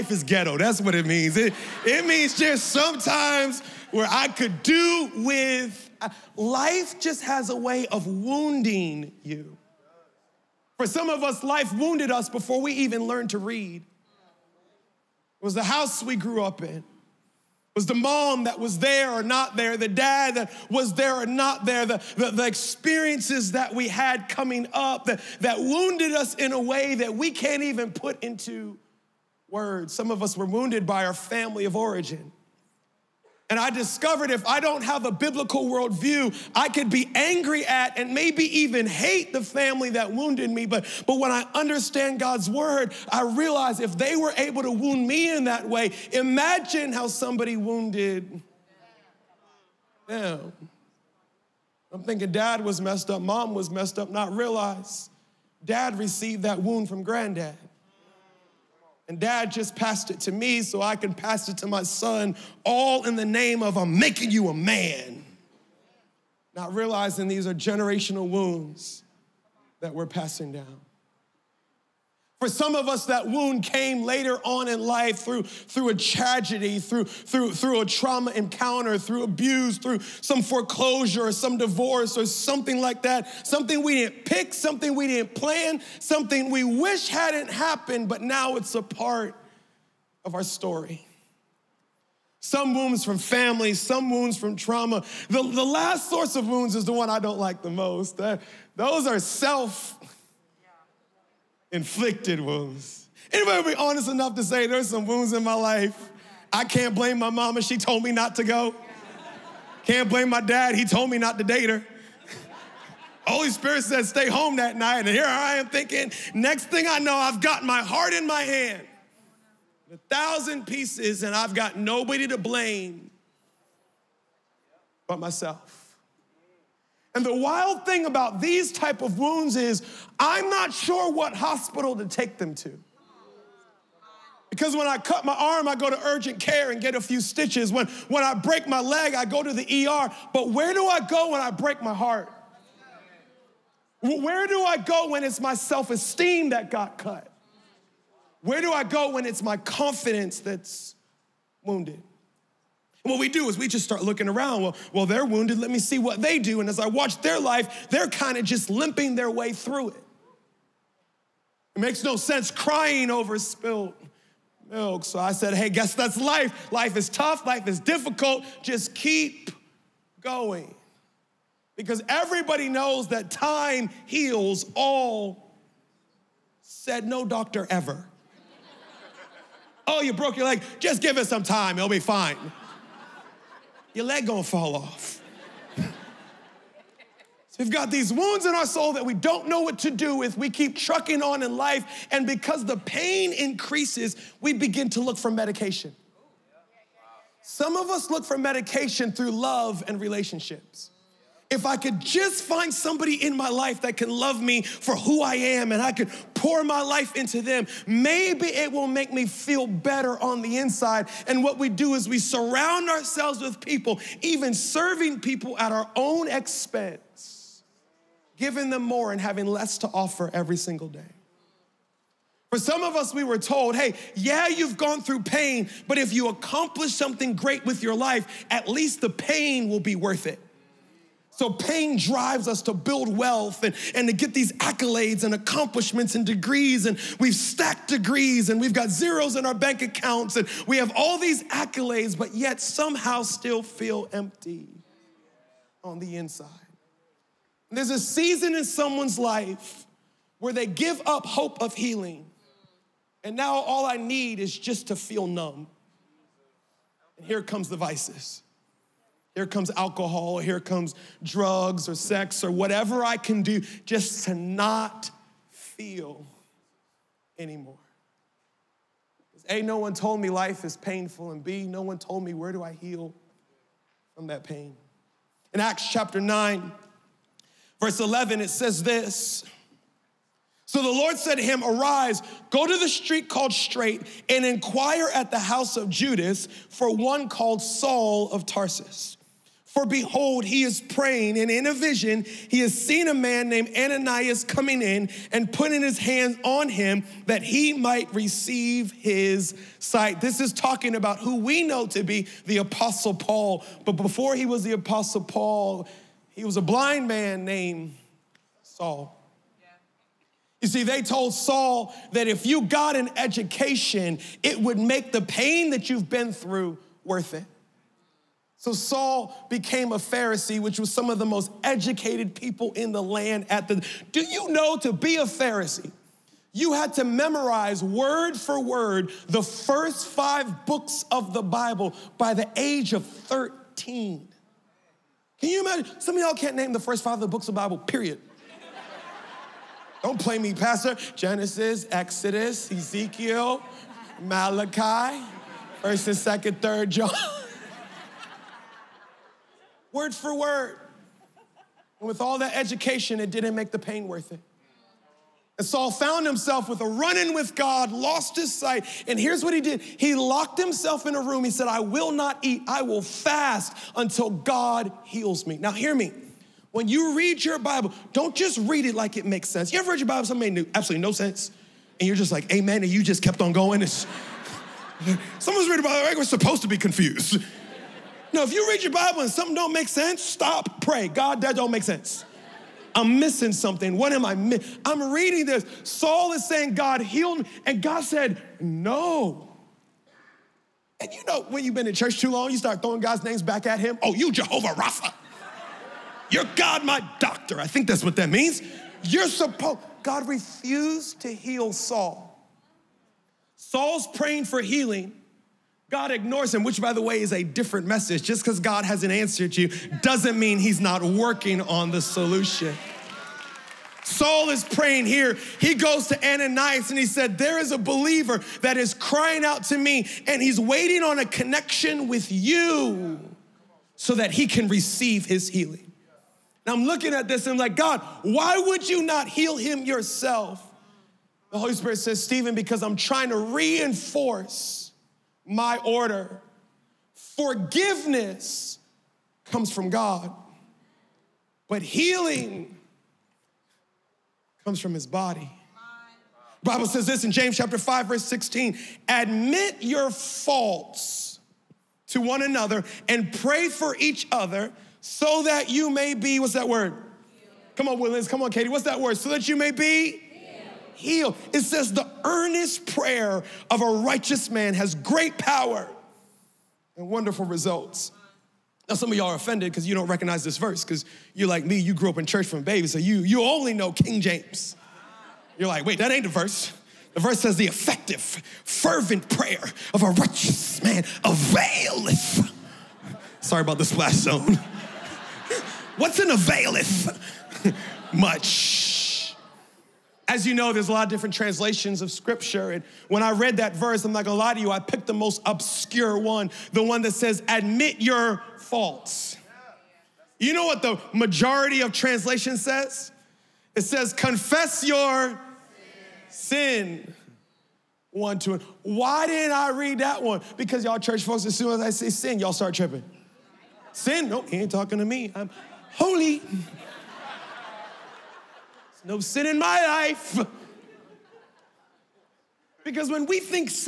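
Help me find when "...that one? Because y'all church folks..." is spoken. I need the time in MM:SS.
08:29.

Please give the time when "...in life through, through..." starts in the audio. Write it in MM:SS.
01:14.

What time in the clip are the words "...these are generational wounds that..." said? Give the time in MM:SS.
01:07.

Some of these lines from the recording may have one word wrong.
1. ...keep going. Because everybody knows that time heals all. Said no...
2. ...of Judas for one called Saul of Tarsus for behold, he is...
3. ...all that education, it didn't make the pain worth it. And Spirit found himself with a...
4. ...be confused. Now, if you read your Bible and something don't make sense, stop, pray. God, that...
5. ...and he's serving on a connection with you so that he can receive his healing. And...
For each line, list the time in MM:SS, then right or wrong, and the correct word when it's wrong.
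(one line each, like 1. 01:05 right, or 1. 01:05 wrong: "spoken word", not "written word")
1. 02:48 right
2. 04:45 right
3. 05:52 wrong: "Saul", not "Spirit"
4. 06:16 right
5. 07:00 wrong: "waiting", not "serving".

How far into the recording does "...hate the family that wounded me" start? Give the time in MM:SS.
00:38.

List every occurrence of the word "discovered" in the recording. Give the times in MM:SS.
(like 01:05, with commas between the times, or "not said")
00:33.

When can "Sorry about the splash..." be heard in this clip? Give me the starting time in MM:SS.
08:03.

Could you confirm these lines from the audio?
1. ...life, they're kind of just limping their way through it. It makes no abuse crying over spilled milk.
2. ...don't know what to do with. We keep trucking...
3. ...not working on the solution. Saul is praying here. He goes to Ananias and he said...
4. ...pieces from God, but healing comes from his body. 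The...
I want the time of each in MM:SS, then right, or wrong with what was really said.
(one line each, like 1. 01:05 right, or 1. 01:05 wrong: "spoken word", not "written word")
1. 02:37 wrong: "sense", not "abuse"
2. 03:09 right
3. 06:50 right
4. 07:19 wrong: "comes", not "pieces".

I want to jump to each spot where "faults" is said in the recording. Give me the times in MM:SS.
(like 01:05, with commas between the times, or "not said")
07:30, 08:18.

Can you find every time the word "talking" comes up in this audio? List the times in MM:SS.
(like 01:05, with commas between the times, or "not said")
05:00, 08:34.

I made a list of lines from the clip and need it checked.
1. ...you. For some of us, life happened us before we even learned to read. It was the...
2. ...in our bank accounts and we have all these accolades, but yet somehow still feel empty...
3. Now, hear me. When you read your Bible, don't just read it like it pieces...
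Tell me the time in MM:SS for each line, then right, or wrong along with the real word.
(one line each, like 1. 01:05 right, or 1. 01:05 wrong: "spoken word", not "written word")
1. 00:09 wrong: "wounded", not "happened"
2. 03:59 right
3. 06:05 wrong: "makes", not "pieces".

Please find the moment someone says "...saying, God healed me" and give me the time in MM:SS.
06:26.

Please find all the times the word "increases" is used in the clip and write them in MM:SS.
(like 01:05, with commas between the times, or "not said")
03:13.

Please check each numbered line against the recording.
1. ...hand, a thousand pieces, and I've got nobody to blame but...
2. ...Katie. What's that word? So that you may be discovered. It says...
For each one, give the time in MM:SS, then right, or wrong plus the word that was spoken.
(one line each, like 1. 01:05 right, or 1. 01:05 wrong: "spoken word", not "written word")
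1. 01:58 right
2. 07:38 wrong: "healed", not "discovered".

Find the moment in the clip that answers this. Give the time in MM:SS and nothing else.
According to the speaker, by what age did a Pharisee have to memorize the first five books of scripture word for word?
05:33.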